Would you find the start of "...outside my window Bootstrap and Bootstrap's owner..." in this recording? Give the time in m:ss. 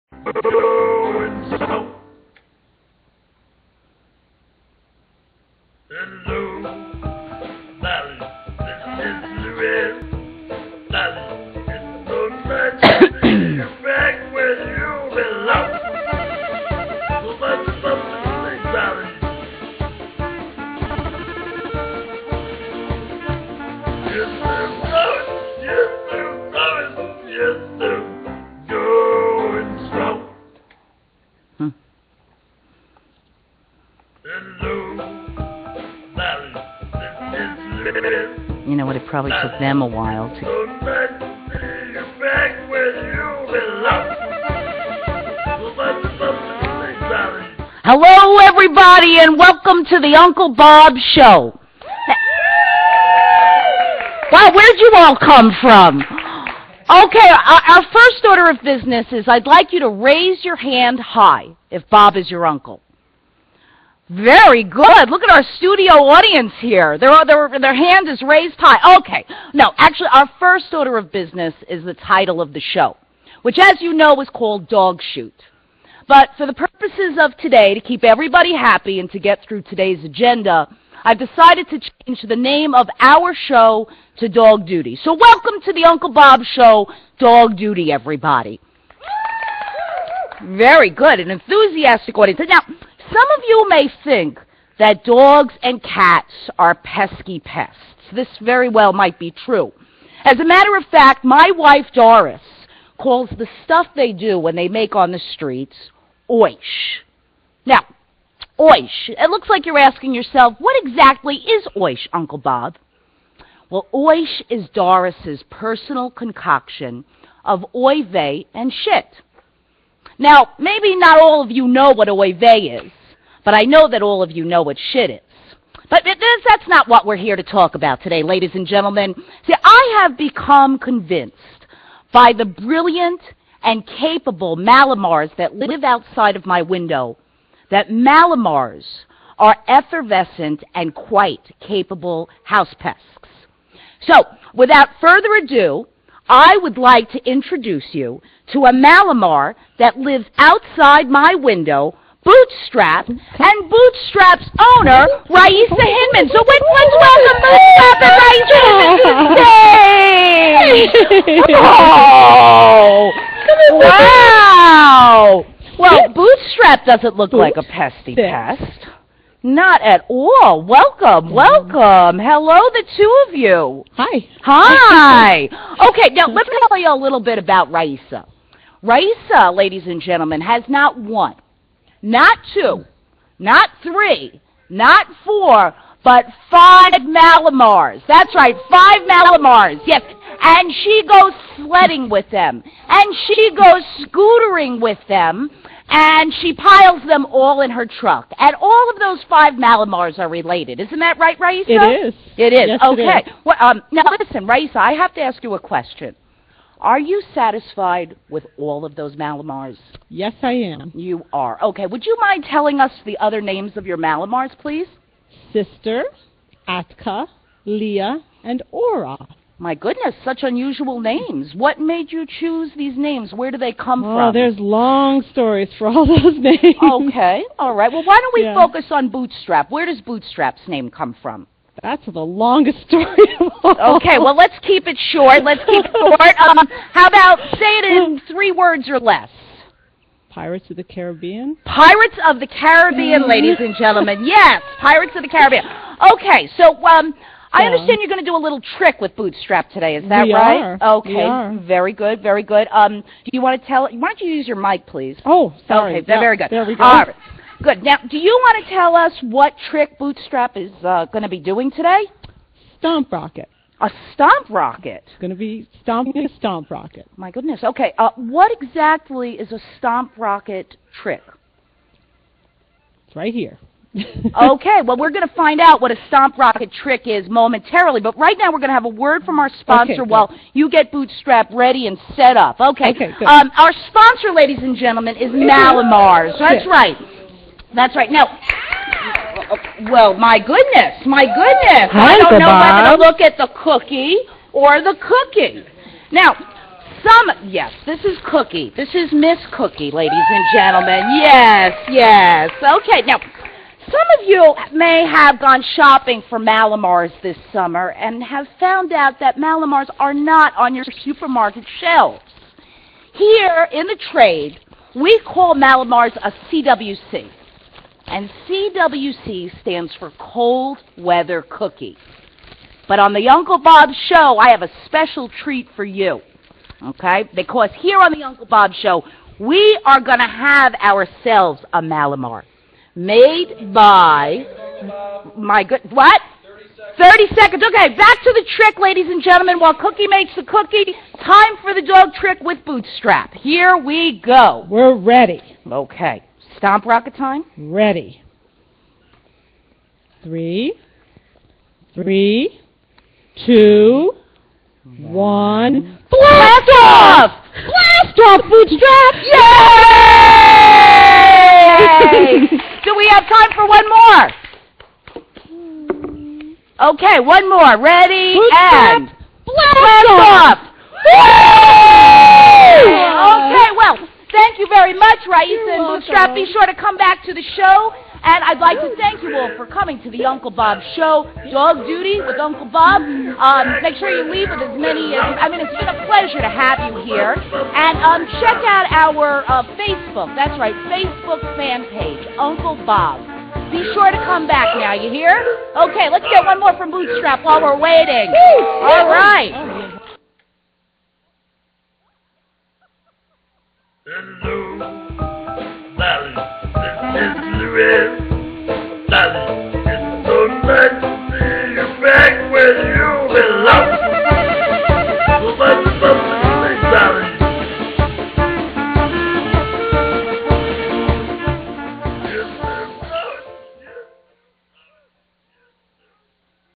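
2:30.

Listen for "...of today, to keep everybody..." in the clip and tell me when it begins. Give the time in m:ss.
1:17.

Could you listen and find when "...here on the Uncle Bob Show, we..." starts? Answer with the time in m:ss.
5:27.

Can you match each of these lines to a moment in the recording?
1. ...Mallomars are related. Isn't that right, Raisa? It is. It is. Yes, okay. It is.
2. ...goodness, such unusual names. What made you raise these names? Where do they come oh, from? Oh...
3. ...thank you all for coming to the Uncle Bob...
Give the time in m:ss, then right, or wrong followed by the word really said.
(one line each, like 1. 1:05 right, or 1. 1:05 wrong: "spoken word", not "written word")
1. 3:19 right
2. 3:39 wrong: "choose", not "raise"
3. 6:18 right.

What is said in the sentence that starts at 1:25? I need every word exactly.
So welcome to the Uncle Bob Show, Dog Duty, everybody.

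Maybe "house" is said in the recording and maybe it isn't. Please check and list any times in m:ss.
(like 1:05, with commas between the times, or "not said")
2:22.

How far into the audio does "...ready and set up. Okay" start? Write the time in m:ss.
4:41.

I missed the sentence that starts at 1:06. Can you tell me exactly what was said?
Their, their, their hand is raised high.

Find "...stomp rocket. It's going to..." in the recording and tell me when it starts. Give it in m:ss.
4:24.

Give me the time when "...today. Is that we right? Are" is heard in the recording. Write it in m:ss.
4:09.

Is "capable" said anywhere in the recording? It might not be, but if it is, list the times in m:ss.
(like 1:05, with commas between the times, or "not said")
2:13, 2:21.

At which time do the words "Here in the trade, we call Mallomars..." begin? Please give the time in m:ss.
5:13.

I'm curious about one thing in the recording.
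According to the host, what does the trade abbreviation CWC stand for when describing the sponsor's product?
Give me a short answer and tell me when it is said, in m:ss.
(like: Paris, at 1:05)
Cold Weather Cookie, at 5:20.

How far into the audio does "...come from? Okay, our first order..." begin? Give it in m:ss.
0:55.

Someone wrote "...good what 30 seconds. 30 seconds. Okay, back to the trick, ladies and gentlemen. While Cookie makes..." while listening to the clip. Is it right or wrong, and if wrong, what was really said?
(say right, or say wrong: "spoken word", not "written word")
right.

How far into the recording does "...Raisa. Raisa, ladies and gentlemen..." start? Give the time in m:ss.
2:57.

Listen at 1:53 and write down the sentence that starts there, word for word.
Well, oish is Doris's personal concoction of oive and shit.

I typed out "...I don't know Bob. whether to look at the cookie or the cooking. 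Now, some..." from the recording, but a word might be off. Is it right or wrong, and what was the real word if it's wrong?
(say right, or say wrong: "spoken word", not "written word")
right.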